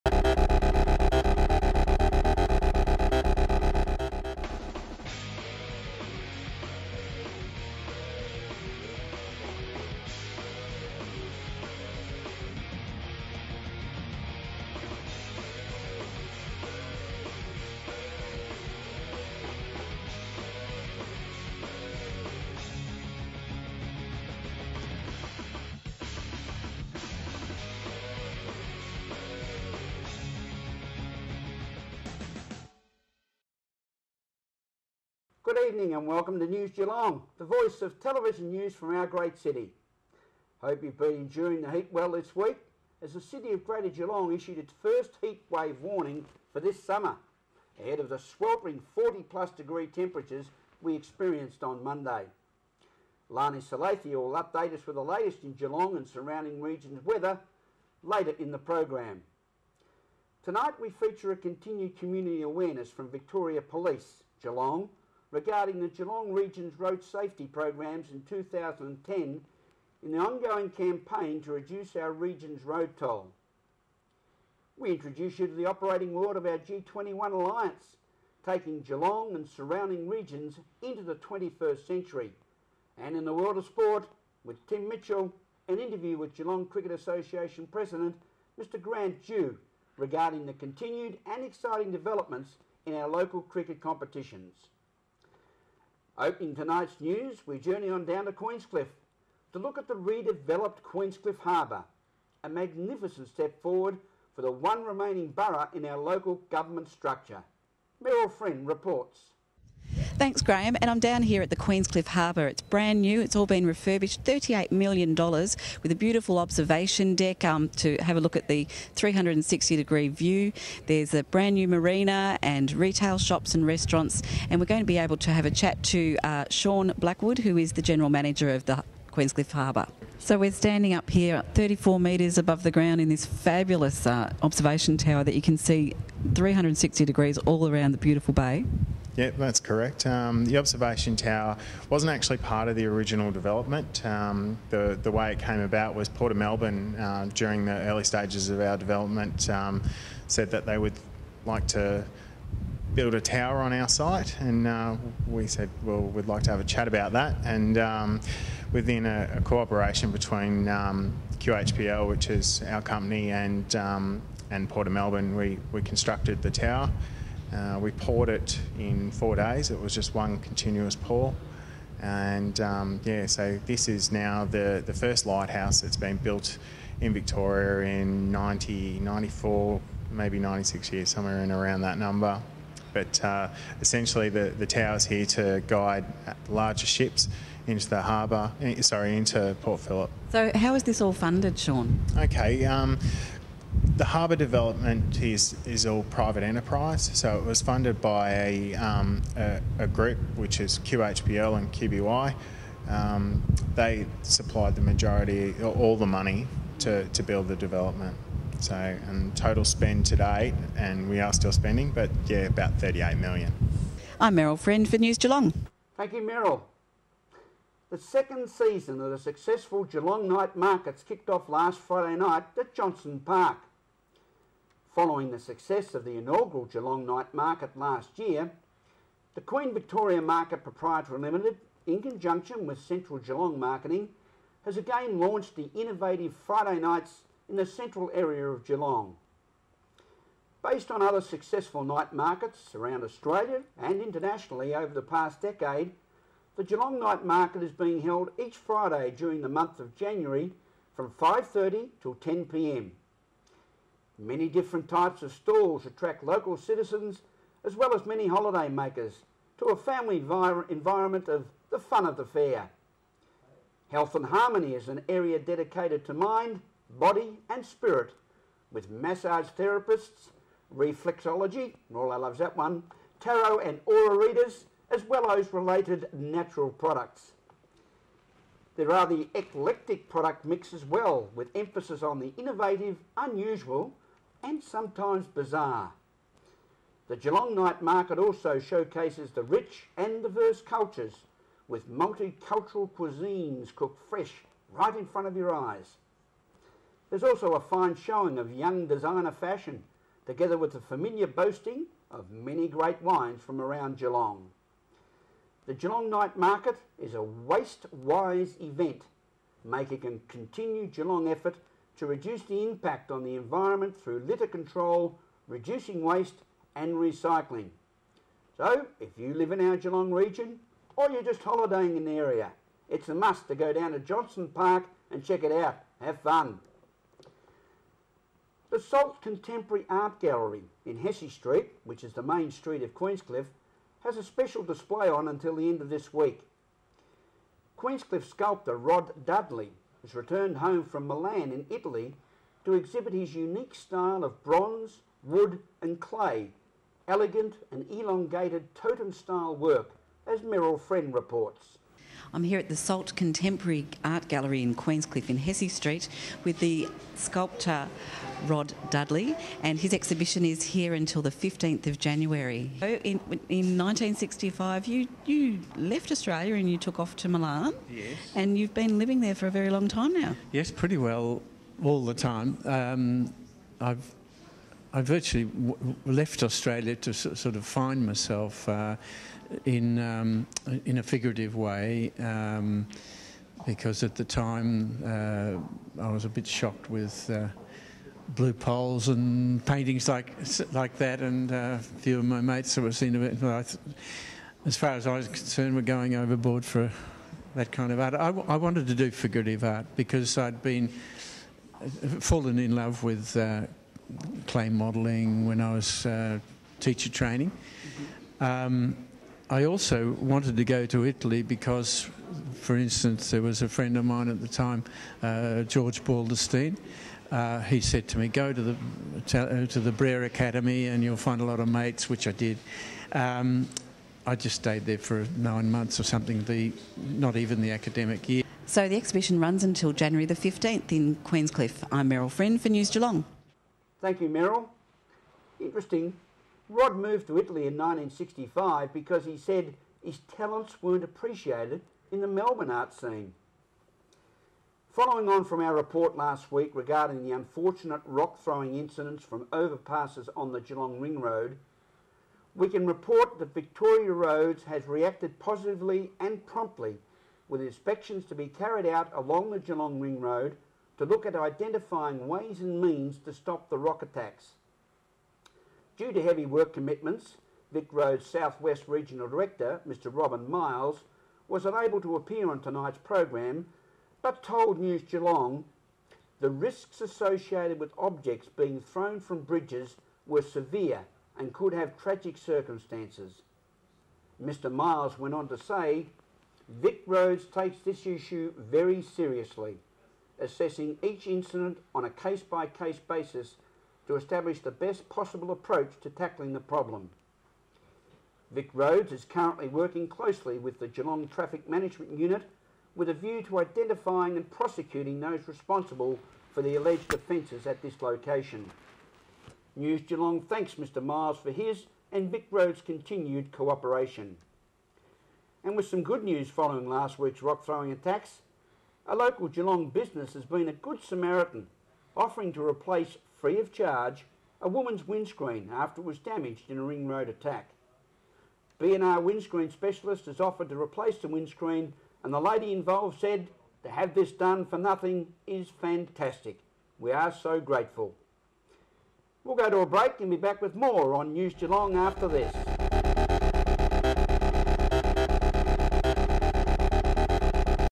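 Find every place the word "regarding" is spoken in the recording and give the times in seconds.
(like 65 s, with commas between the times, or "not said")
65 s, 89 s, 446 s.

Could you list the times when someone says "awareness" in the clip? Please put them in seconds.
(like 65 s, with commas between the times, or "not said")
62 s.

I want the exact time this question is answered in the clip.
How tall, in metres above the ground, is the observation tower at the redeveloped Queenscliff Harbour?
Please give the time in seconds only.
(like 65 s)
131 s.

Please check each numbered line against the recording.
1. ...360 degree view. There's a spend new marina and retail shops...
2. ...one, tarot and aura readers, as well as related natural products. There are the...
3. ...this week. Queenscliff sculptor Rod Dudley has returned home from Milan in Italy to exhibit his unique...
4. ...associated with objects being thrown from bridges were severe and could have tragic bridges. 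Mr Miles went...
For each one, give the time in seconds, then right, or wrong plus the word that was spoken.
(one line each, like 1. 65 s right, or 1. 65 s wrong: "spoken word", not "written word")
1. 118 s wrong: "brand", not "spend"
2. 272 s right
3. 335 s right
4. 477 s wrong: "circumstances", not "bridges".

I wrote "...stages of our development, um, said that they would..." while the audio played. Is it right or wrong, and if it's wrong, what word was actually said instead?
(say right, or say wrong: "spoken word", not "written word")
right.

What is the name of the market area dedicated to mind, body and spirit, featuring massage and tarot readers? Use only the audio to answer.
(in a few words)
Health and Harmony.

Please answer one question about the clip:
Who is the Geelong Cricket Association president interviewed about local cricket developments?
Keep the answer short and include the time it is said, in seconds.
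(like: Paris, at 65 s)
Grant Dew, at 88 s.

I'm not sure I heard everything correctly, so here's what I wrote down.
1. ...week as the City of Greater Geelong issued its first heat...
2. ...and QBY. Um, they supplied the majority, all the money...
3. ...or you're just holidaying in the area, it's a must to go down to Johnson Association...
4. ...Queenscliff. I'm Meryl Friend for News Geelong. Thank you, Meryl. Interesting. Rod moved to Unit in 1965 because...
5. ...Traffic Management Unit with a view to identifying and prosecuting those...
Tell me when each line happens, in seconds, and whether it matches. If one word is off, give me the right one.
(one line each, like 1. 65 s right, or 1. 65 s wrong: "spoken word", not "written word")
1. 42 s right
2. 201 s right
3. 320 s wrong: "Park", not "Association"
4. 431 s wrong: "Italy", not "Unit"
5. 501 s right.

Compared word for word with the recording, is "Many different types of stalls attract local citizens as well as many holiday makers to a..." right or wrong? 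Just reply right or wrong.
right.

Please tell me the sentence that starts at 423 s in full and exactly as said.
Um, I just stayed there for nine months or something.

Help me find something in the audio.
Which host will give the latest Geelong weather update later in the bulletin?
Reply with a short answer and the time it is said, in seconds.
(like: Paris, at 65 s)
Larni Salathiel, at 53 s.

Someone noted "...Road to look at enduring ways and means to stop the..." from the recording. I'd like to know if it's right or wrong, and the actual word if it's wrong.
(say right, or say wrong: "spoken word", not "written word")
wrong: "identifying", not "enduring".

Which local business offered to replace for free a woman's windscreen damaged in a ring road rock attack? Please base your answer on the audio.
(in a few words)
B&R Windscreen Specialist.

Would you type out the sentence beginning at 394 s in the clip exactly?
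as far as I was concerned, were going overboard for that kind of art.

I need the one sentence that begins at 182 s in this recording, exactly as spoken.
But uh, essentially, the, the tower's here to guide uh, larger ships into the harbour, eh, sorry, into Port Phillip.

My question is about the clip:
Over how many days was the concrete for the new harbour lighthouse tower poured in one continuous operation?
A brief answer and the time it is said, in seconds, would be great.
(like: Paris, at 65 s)
4 days, at 169 s.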